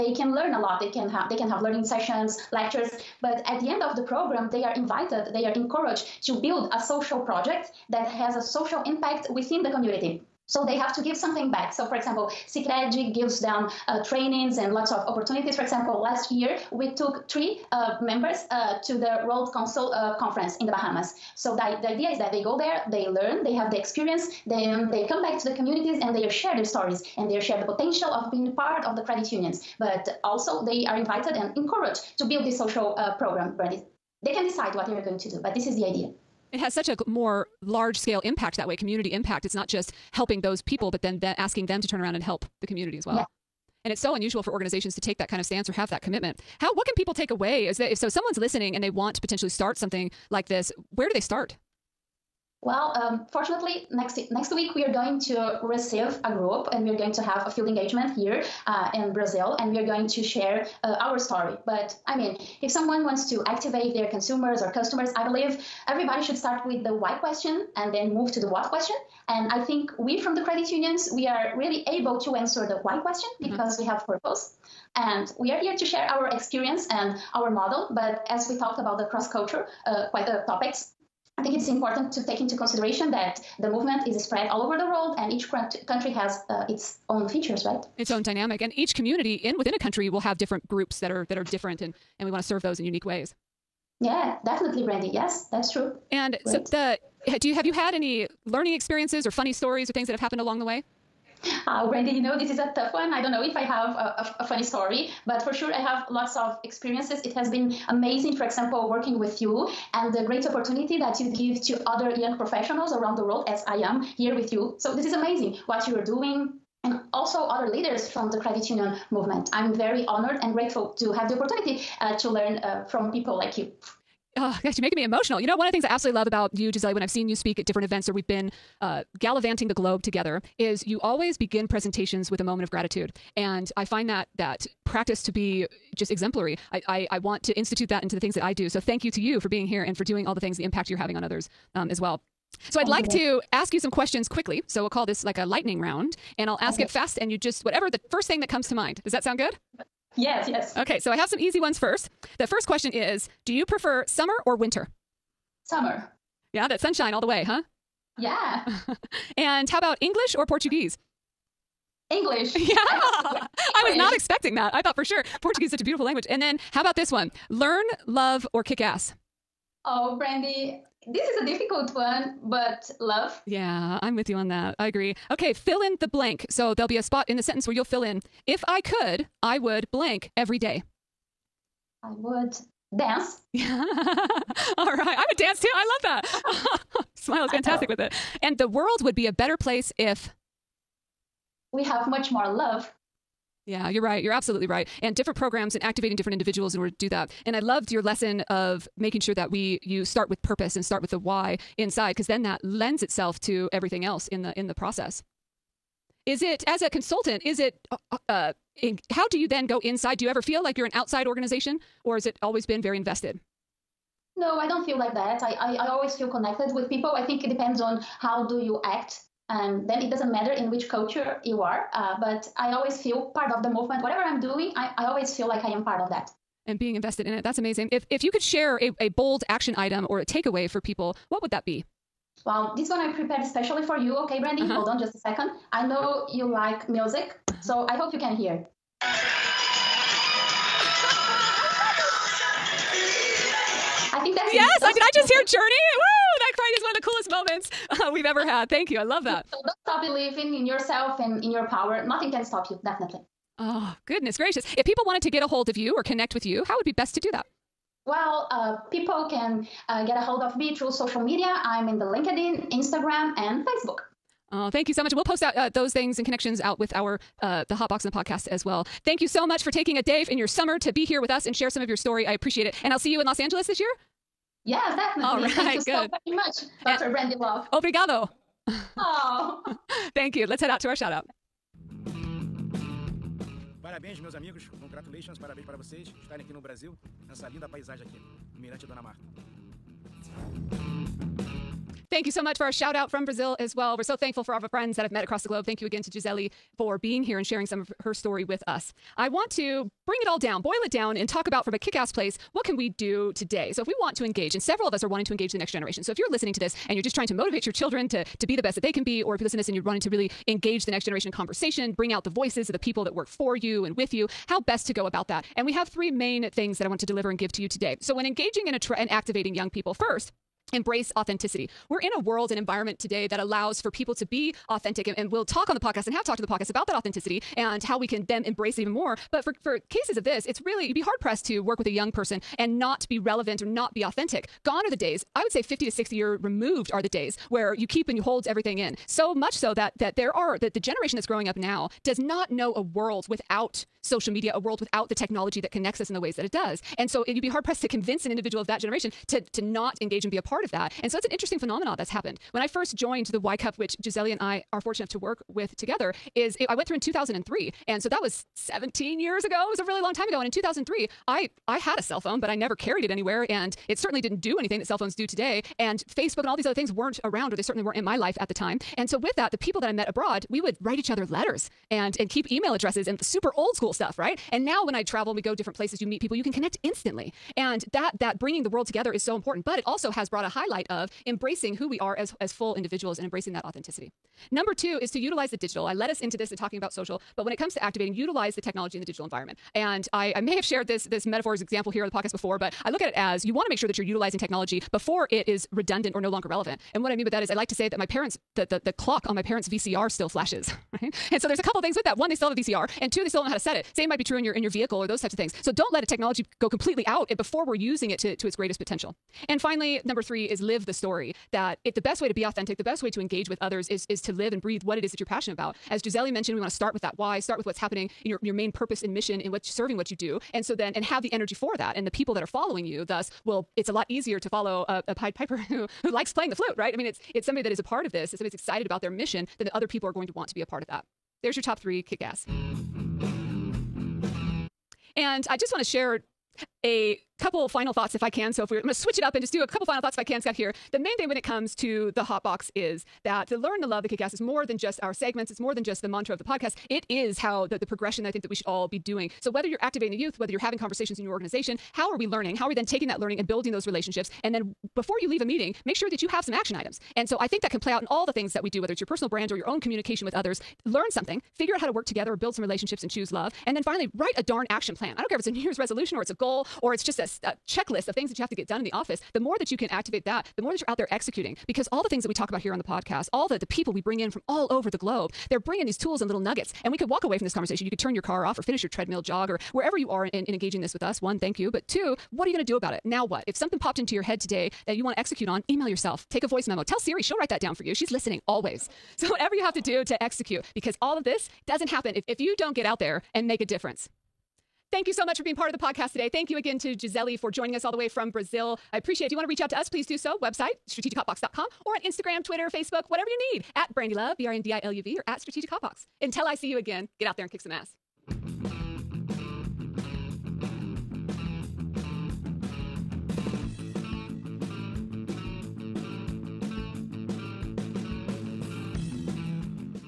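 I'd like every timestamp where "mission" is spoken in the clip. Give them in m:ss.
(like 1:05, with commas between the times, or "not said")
6:59, 7:09.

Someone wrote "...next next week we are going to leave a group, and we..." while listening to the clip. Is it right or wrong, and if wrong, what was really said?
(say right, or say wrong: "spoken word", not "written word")
wrong: "receive", not "leave".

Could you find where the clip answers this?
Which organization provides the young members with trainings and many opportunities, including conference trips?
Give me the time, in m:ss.
0:12.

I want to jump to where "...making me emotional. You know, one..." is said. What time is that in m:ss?
2:04.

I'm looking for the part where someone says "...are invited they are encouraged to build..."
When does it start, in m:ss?
0:04.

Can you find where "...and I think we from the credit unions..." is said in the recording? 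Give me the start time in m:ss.
1:09.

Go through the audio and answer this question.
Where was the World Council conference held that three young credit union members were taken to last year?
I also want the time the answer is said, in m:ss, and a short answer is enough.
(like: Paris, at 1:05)
the Bahamas, at 0:20.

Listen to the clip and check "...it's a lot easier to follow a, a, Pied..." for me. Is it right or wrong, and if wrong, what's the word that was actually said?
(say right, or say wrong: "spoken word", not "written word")
right.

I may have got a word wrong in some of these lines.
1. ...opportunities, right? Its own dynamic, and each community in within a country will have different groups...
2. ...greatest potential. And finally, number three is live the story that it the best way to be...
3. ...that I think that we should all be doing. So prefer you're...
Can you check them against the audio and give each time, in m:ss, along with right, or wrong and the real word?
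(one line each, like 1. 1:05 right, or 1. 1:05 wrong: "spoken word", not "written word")
1. 1:27 wrong: "features", not "opportunities"
2. 6:48 right
3. 7:28 wrong: "whether", not "prefer".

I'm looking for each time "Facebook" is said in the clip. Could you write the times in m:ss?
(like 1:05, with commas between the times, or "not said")
4:23, 6:06, 8:22.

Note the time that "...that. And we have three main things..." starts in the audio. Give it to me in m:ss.
5:15.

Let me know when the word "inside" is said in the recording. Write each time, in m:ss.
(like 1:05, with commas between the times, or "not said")
3:21, 3:29.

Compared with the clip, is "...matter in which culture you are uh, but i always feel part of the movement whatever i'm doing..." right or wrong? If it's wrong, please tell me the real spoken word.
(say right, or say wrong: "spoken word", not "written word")
right.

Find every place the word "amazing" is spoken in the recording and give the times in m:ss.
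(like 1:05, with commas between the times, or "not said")
1:47, 1:55, 3:47.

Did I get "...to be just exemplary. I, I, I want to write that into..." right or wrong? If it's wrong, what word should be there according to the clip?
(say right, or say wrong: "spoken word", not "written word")
wrong: "institute", not "write".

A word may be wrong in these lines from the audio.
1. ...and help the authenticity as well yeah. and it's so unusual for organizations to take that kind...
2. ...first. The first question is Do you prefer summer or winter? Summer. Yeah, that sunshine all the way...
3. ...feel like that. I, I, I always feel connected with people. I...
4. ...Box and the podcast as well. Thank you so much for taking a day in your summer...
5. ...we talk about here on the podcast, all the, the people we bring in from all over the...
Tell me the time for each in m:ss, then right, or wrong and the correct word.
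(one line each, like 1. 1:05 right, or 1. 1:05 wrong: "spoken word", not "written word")
1. 0:42 wrong: "community", not "authenticity"
2. 2:31 right
3. 3:34 right
4. 4:27 right
5. 7:52 right.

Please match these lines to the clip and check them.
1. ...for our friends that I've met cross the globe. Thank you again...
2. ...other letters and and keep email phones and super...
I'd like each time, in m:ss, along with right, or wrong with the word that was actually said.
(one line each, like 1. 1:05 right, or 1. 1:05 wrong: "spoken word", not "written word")
1. 4:54 wrong: "across", not "cross"
2. 6:11 wrong: "addresses", not "phones".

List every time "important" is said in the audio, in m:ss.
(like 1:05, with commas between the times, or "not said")
1:21, 6:19.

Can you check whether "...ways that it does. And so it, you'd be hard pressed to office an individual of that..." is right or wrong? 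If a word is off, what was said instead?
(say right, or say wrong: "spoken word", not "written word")
wrong: "convince", not "office".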